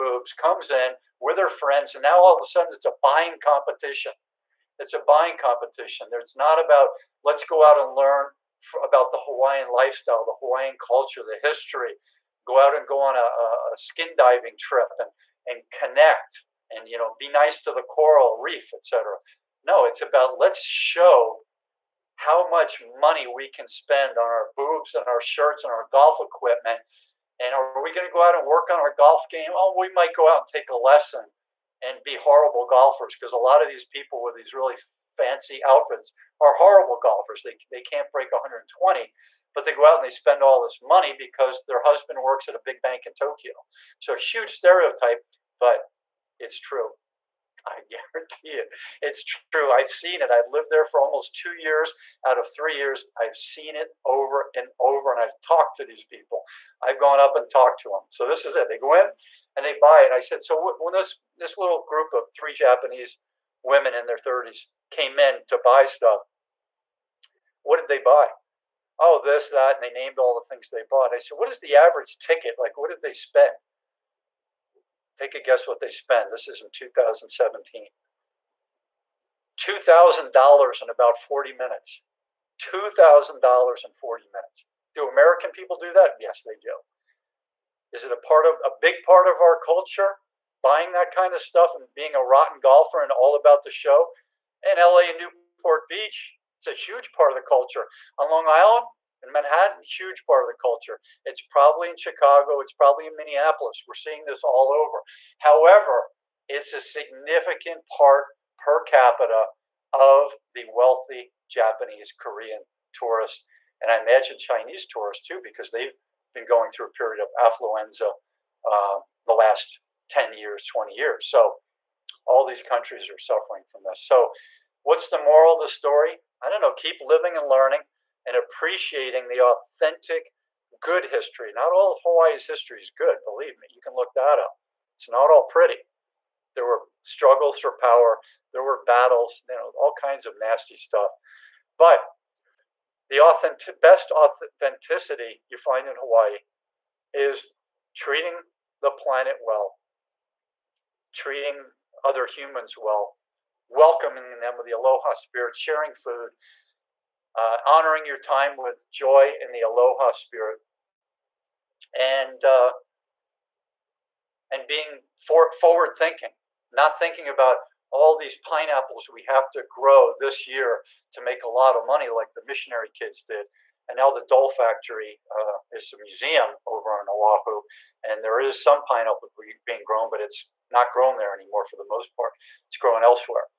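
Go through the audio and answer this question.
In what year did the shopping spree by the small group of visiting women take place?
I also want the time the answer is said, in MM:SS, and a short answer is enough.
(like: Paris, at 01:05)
2017, at 01:16.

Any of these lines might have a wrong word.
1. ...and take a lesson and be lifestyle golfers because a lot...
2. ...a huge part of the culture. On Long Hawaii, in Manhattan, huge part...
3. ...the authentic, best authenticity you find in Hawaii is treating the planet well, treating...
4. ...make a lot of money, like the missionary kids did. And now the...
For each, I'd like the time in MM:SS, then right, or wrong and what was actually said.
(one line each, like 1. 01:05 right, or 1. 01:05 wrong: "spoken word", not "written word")
1. 00:30 wrong: "horrible", not "lifestyle"
2. 01:36 wrong: "Island", not "Hawaii"
3. 02:23 right
4. 02:51 right.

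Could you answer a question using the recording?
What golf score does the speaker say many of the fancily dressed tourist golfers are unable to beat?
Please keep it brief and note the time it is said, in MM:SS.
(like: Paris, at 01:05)
120, at 00:38.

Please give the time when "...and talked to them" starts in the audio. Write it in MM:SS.
00:57.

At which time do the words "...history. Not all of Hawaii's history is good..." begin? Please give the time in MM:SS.
02:11.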